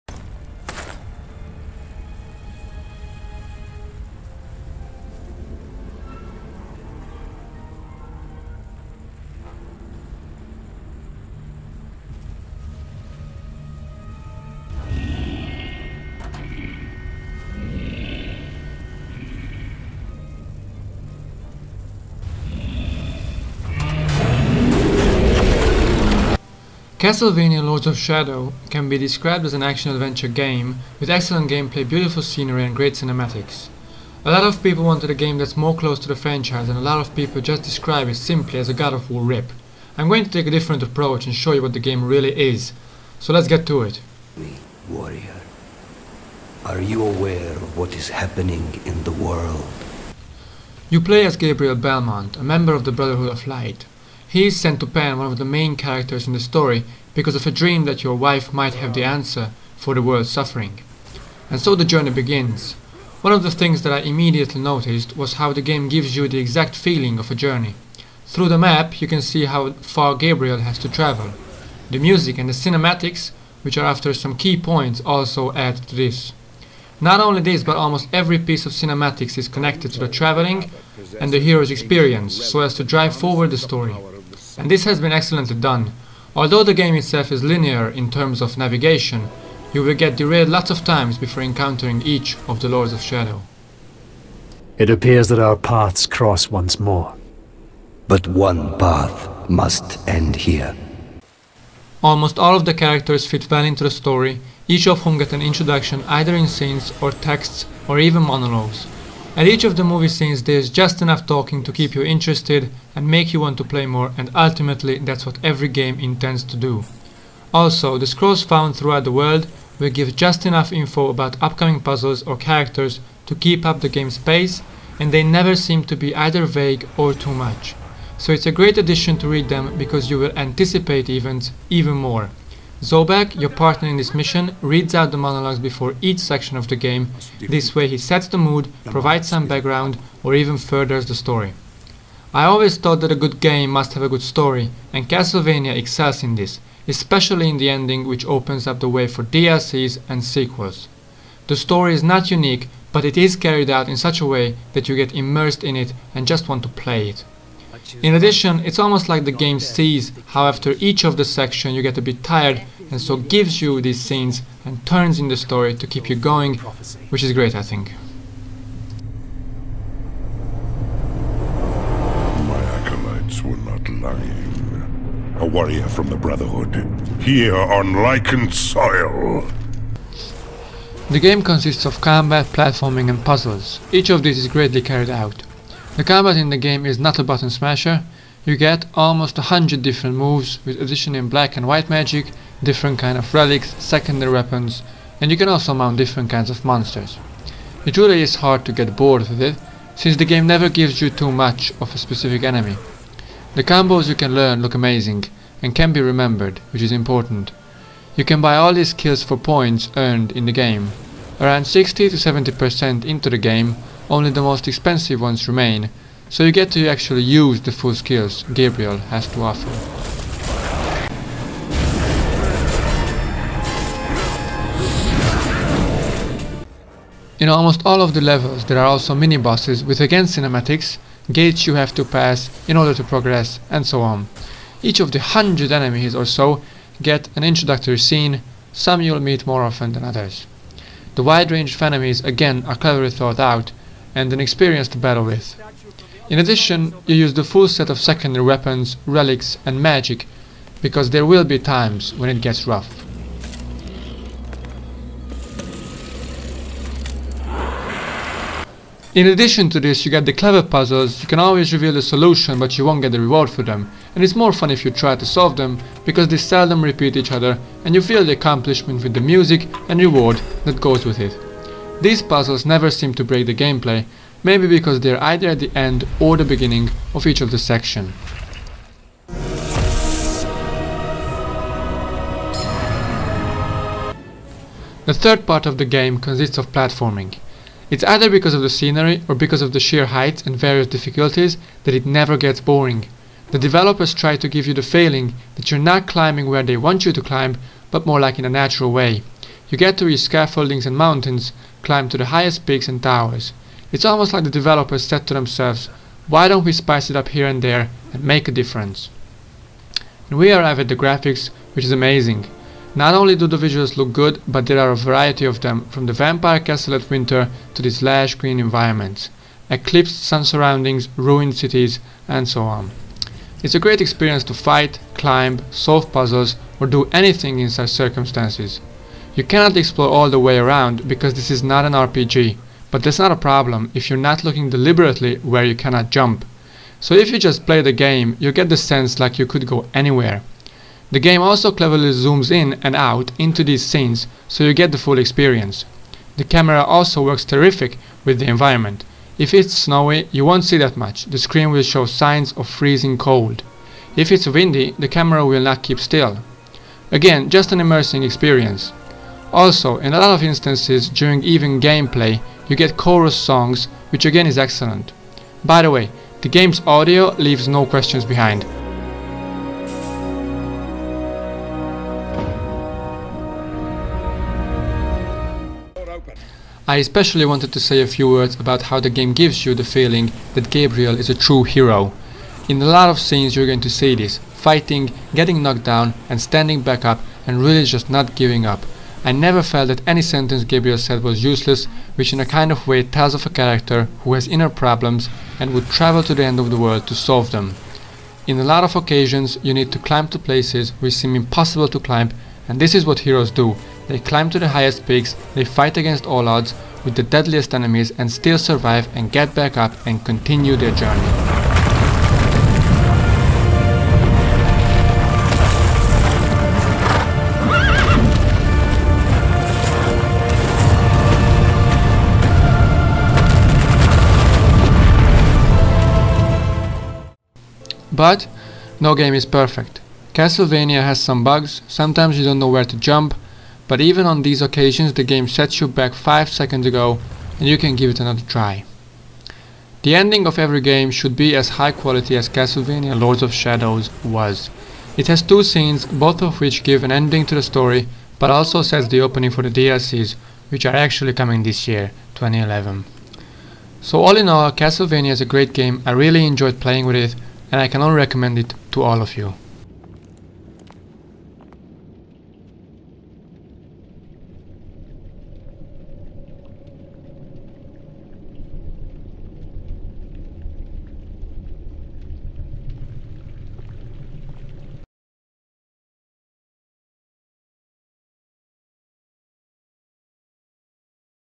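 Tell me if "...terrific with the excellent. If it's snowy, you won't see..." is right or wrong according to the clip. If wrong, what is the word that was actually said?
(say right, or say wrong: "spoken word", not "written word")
wrong: "environment", not "excellent".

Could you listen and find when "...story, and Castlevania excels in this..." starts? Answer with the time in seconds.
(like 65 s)
144 s.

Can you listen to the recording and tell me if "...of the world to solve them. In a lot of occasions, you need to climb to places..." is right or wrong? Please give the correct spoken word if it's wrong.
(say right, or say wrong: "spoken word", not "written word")
right.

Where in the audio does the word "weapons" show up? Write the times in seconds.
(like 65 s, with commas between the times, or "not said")
194 s, 248 s.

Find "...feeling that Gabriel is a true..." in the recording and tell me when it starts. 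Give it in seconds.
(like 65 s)
379 s.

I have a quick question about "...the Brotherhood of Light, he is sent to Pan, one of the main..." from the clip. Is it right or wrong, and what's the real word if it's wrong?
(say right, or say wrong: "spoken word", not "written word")
right.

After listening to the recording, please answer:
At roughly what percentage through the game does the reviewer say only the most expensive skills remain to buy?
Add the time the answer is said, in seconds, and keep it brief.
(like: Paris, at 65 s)
60 to 70%, at 211 s.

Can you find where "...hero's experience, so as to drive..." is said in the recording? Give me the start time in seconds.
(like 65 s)
81 s.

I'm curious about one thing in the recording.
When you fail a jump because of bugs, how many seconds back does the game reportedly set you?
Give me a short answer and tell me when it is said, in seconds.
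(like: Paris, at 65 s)
5 seconds, at 436 s.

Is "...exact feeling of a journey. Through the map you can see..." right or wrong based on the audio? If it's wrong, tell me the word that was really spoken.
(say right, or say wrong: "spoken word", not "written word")
right.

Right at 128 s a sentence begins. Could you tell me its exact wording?
So it's a great addition to read them because you will anticipate events even more.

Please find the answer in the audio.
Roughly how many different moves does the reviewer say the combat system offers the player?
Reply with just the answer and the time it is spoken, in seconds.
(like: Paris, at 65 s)
almost 100, at 188 s.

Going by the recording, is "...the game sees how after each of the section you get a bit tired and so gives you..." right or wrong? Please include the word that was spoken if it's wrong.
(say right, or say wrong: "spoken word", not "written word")
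right.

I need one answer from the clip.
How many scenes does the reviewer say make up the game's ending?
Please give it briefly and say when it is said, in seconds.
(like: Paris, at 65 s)
2, at 445 s.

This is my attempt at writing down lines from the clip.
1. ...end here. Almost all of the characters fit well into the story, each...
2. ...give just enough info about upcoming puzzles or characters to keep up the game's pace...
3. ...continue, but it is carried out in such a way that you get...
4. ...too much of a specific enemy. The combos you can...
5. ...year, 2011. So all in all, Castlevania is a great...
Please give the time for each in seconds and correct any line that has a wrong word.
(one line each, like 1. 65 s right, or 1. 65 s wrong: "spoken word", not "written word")
1. 100 s right
2. 119 s right
3. 152 s wrong: "unique", not "continue"
4. 201 s right
5. 451 s right.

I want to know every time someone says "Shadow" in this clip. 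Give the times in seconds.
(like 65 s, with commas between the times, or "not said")
27 s, 93 s, 443 s.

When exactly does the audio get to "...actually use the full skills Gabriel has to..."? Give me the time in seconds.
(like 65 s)
216 s.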